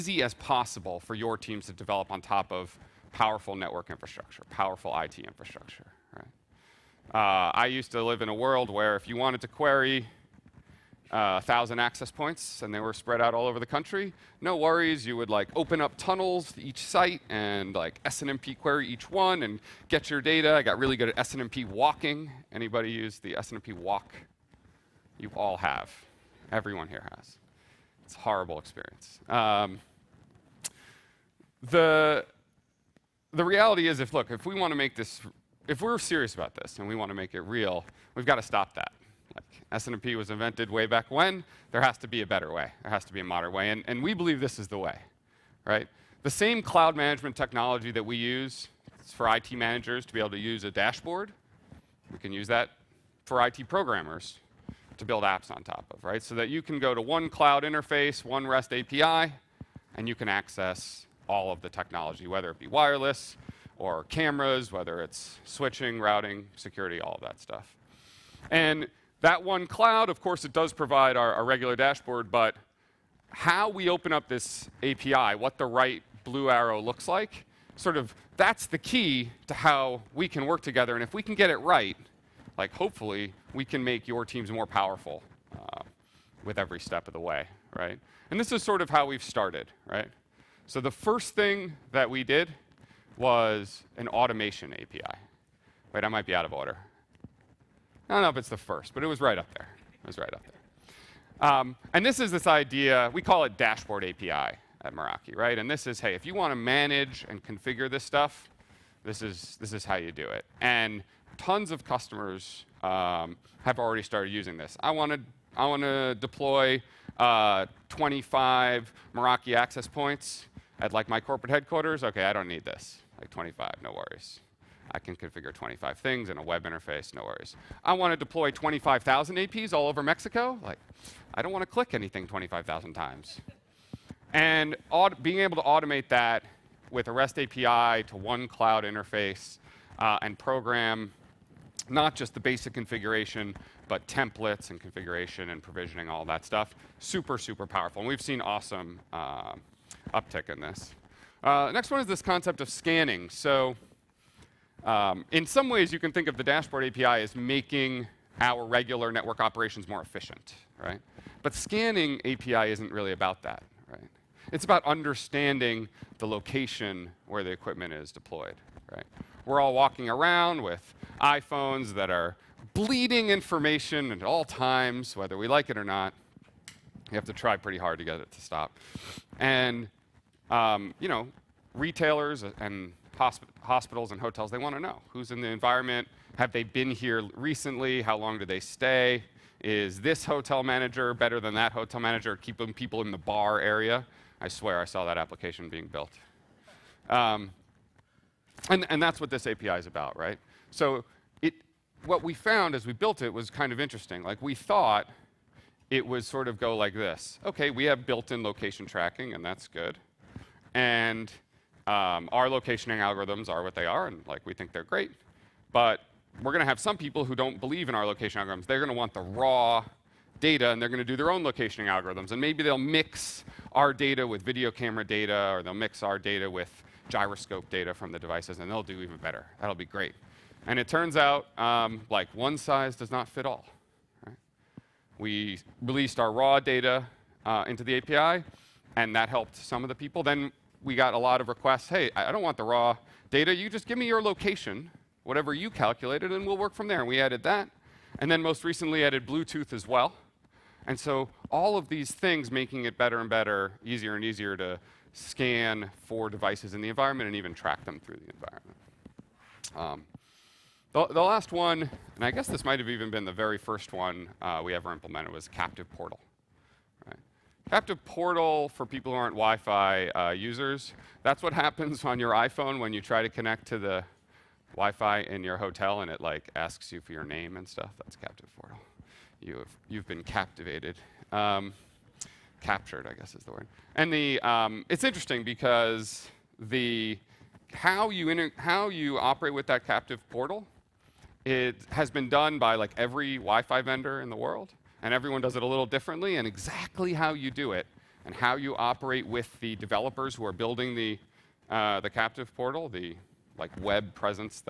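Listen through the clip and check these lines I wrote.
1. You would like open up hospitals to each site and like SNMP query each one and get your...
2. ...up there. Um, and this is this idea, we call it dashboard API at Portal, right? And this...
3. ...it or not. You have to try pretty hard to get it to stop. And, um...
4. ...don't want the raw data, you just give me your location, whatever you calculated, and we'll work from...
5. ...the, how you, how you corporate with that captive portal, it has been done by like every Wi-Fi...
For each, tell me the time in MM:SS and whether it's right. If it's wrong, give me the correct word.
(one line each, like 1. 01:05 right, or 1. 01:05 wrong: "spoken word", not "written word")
1. 00:15 wrong: "tunnels", not "hospitals"
2. 01:40 wrong: "Meraki", not "Portal"
3. 02:55 right
4. 04:02 right
5. 04:46 wrong: "operate", not "corporate".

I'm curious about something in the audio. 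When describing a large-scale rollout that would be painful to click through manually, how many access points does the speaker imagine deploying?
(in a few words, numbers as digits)
25,000.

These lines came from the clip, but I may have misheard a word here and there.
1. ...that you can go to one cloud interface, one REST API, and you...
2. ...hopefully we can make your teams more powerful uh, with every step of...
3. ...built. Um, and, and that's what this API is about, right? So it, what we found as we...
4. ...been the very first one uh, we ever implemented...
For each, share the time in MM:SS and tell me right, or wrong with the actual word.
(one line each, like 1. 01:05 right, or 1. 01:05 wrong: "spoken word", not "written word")
1. 00:56 right
2. 01:22 right
3. 03:15 right
4. 04:23 right.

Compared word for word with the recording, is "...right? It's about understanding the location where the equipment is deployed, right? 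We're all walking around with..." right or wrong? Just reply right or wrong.
right.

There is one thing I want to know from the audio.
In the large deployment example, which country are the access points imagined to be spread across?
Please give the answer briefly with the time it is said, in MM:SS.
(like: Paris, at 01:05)
Mexico, at 02:10.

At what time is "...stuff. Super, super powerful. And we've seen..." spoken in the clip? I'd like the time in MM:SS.
02:26.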